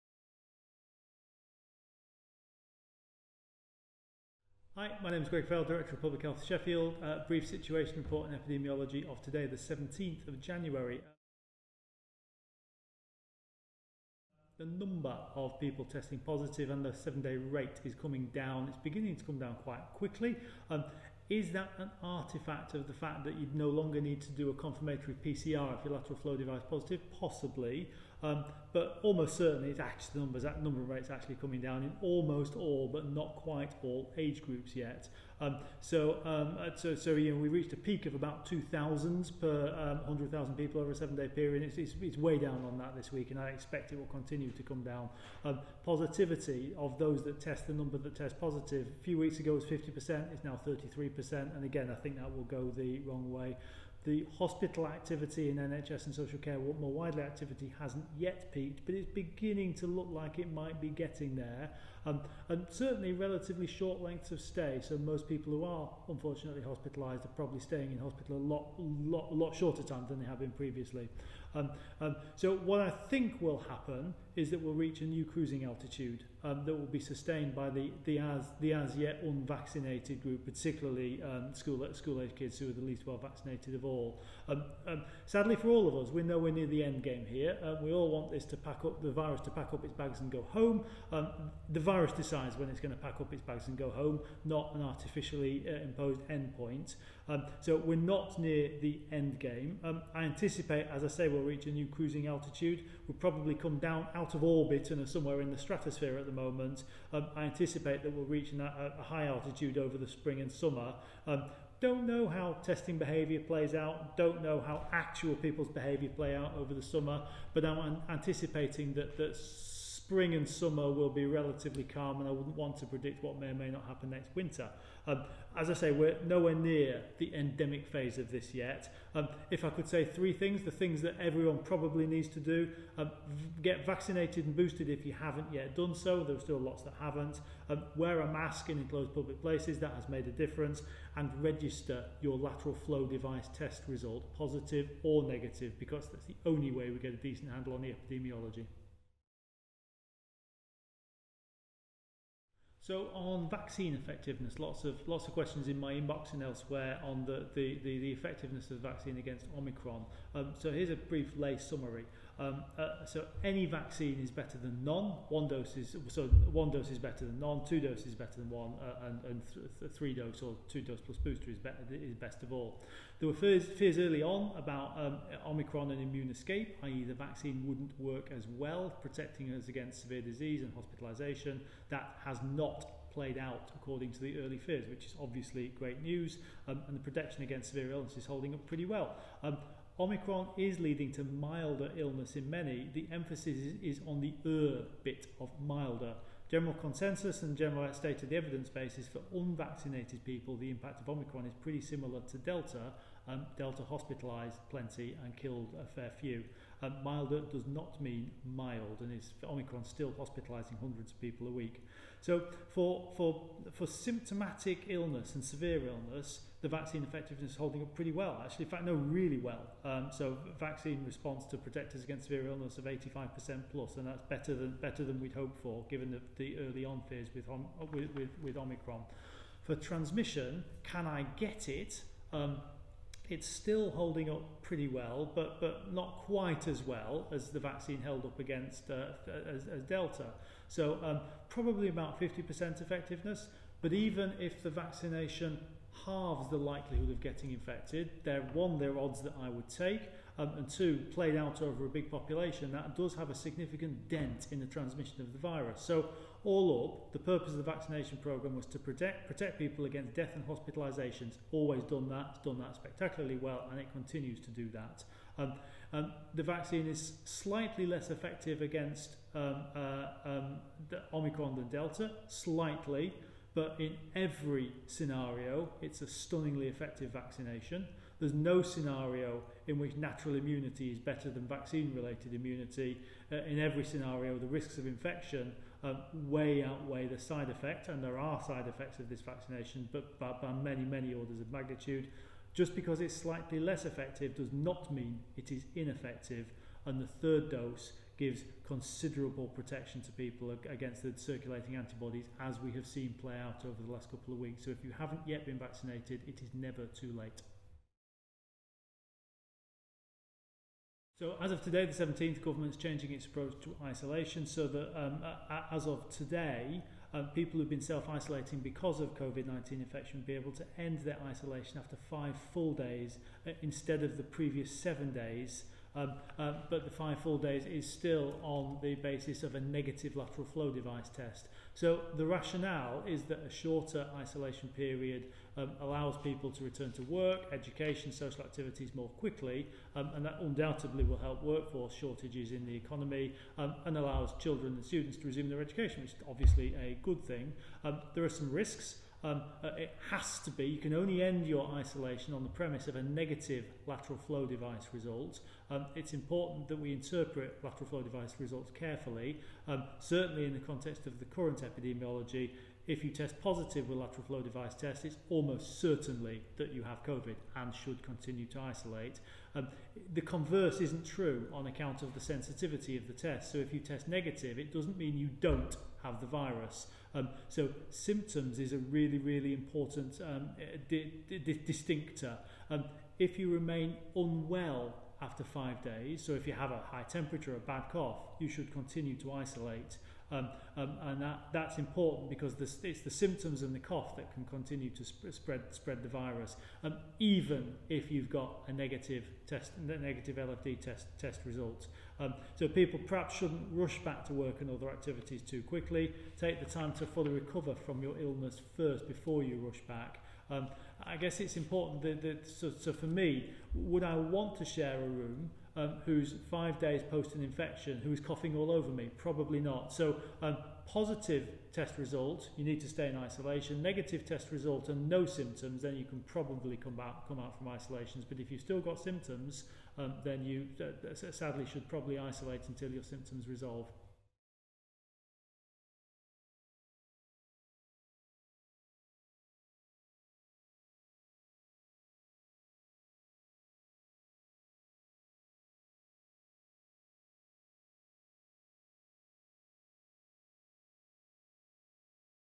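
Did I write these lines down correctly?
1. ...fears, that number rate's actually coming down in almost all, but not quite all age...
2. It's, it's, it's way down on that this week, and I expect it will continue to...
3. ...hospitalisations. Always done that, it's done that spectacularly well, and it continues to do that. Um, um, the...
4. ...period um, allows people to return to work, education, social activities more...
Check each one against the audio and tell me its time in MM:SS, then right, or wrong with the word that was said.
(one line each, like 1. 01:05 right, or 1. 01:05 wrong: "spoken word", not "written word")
1. 00:30 wrong: "numbers", not "fears"
2. 00:41 right
3. 04:20 right
4. 05:34 right.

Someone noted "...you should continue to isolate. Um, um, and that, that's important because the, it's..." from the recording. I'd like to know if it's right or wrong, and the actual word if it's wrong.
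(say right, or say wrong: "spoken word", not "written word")
right.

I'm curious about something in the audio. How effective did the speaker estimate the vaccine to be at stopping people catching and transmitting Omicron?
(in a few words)
About 50%.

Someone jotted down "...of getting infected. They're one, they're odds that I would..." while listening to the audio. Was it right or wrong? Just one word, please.
right.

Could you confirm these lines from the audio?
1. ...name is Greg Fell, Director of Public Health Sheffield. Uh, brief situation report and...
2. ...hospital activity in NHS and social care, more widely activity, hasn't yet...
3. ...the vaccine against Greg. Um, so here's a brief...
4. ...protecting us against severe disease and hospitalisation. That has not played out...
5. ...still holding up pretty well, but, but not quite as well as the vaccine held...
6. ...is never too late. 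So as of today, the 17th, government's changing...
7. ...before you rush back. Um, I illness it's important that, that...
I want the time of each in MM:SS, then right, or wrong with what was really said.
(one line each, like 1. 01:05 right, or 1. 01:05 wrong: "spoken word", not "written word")
1. 00:05 right
2. 00:54 right
3. 02:38 wrong: "Omicron", not "Greg"
4. 02:59 right
5. 03:53 right
6. 05:06 right
7. 06:49 wrong: "guess", not "illness".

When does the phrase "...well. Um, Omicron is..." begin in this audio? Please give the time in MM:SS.
03:08.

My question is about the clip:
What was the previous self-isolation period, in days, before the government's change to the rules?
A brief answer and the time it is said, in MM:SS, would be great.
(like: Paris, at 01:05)
7, at 05:24.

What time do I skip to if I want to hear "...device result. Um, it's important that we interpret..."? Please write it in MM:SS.
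05:54.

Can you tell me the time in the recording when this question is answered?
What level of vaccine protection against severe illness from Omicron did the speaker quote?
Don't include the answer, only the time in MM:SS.
03:42.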